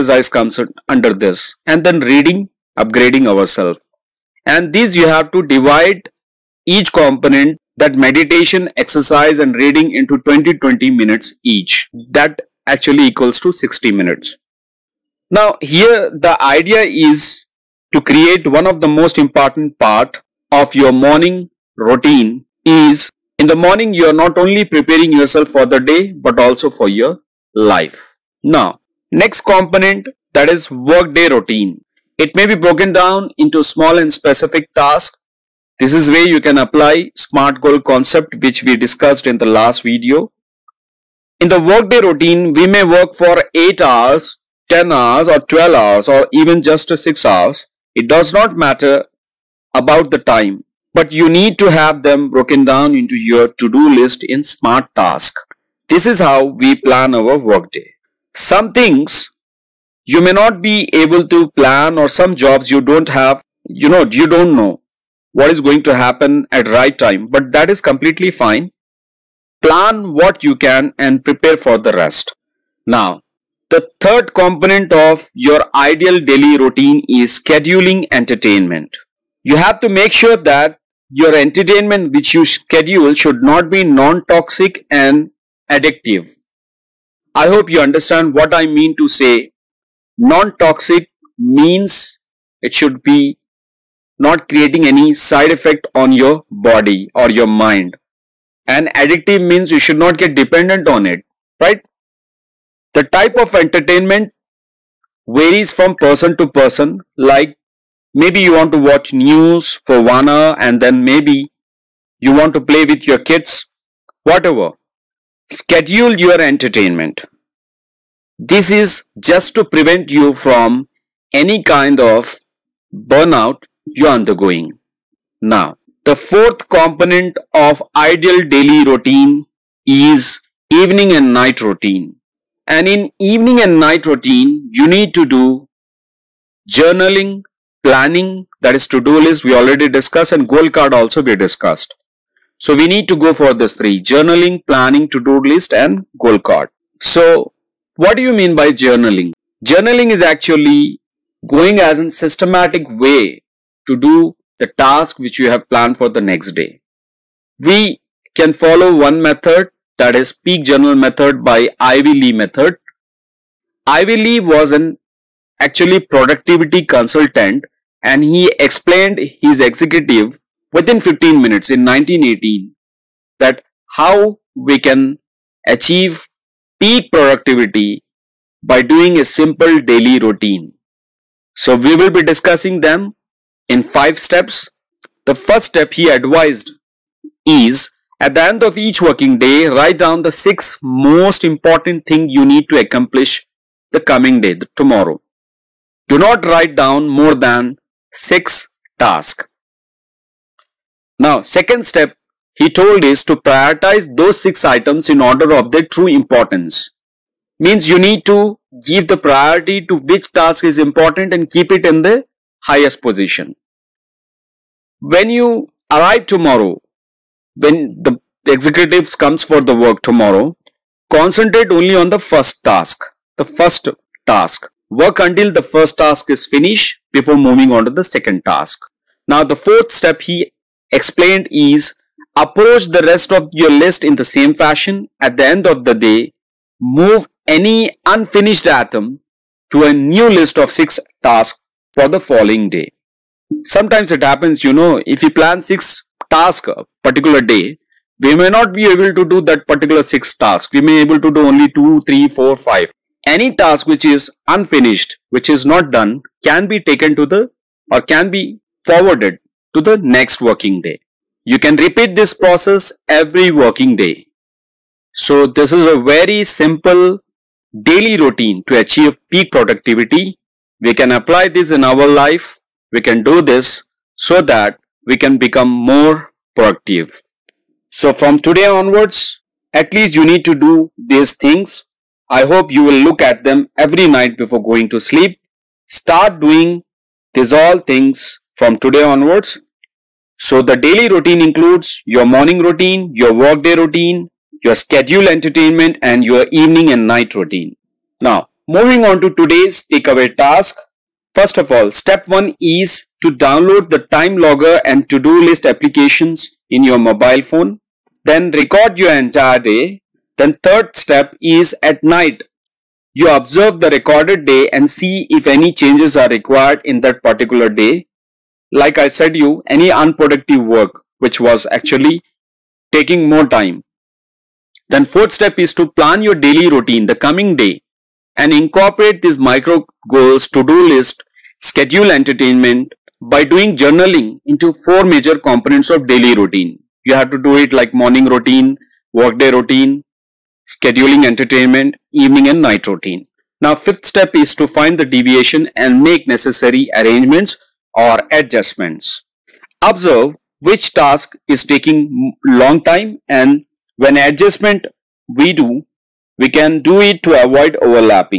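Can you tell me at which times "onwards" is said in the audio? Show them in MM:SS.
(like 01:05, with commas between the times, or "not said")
04:38, 04:49.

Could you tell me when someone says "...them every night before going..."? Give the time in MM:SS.
04:43.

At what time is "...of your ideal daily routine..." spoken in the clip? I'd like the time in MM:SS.
01:14.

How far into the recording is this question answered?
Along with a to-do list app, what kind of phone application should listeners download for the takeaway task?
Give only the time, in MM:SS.
05:03.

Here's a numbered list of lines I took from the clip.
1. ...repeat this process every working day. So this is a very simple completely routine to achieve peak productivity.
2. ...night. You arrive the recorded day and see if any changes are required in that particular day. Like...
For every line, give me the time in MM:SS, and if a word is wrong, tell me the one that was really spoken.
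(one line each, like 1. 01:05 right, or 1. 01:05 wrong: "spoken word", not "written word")
1. 04:21 wrong: "daily", not "completely"
2. 05:12 wrong: "observe", not "arrive".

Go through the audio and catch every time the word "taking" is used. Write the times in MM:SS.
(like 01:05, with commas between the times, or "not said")
05:22, 05:51.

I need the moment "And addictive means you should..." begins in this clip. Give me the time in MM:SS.
01:38.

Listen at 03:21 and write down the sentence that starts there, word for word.
Now, second step he told is to prioritize those six items in order of their true importance.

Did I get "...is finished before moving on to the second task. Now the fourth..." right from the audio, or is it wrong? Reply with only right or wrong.
right.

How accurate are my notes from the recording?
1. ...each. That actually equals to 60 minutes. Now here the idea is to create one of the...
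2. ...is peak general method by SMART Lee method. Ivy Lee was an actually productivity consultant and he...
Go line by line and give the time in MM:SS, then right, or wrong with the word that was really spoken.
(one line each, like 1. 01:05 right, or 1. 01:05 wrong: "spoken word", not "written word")
1. 00:11 right
2. 02:40 wrong: "Ivy", not "SMART".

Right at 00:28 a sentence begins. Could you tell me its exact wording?
Now next component that is workday routine.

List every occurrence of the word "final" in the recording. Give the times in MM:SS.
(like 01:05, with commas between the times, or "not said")
not said.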